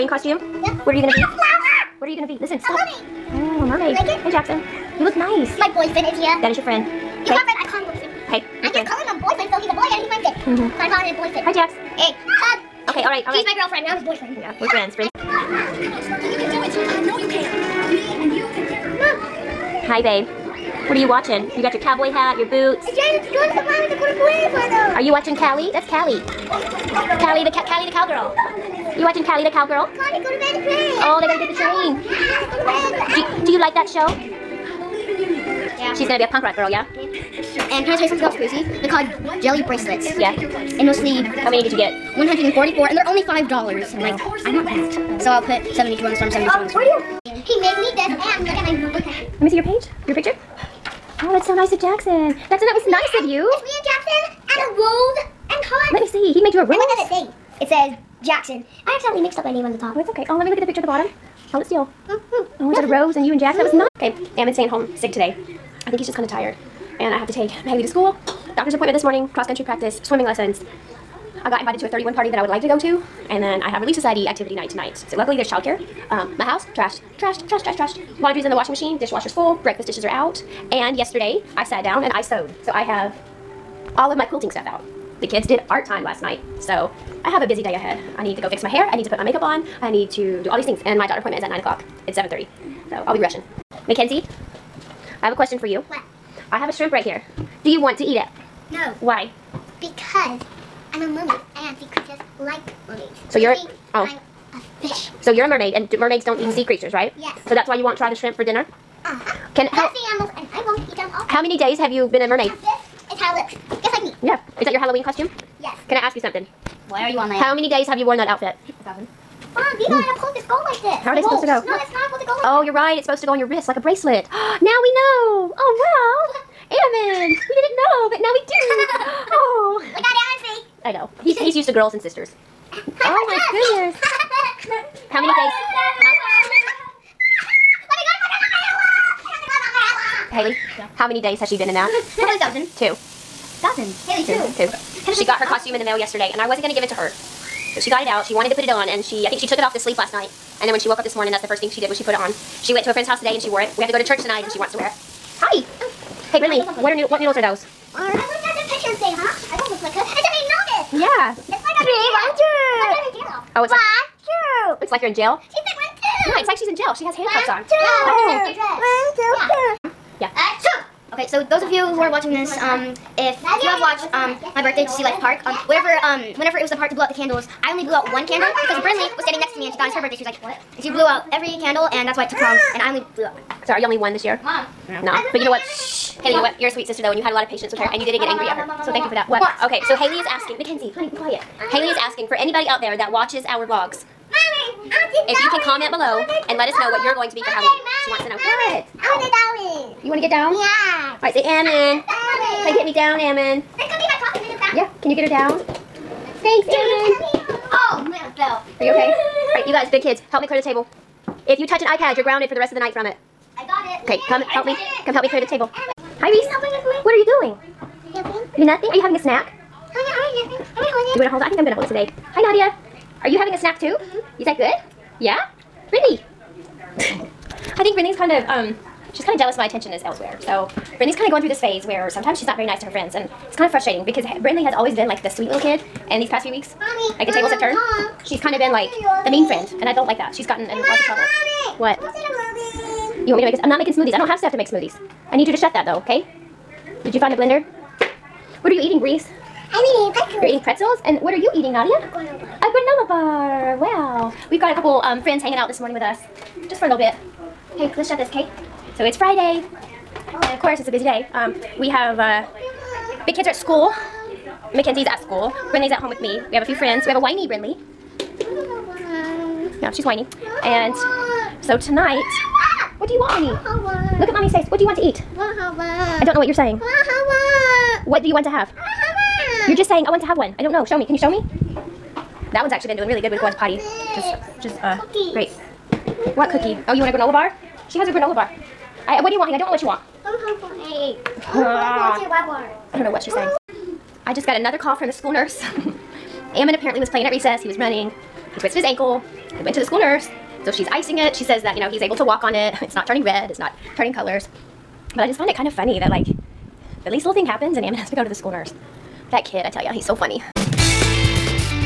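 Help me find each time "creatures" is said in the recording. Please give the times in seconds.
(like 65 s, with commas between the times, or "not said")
101 s, 106 s.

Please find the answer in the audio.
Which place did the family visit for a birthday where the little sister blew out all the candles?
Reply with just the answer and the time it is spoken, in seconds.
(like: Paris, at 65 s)
Sea Life Park, at 174 s.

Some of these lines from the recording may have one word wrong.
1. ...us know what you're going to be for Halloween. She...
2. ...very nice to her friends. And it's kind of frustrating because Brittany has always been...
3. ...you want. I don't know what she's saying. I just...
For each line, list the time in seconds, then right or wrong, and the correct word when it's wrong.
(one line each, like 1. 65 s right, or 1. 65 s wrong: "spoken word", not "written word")
1. 196 s right
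2. 232 s right
3. 289 s right.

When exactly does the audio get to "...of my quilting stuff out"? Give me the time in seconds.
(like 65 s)
84 s.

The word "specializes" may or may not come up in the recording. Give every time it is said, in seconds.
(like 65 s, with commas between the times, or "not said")
not said.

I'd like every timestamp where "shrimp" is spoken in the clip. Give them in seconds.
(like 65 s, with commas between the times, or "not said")
96 s, 108 s.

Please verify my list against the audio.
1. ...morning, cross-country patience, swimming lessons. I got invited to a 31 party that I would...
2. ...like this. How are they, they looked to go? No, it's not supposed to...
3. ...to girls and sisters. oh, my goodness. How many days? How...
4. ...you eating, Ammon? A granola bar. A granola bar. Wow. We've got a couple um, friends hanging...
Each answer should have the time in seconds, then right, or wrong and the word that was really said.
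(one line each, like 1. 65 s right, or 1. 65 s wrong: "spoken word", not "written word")
1. 69 s wrong: "practice", not "patience"
2. 120 s wrong: "supposed", not "looked"
3. 131 s right
4. 251 s wrong: "Nadia", not "Ammon".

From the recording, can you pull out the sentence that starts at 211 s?
If you touch an iPad, you're grounded for the rest of the night from it.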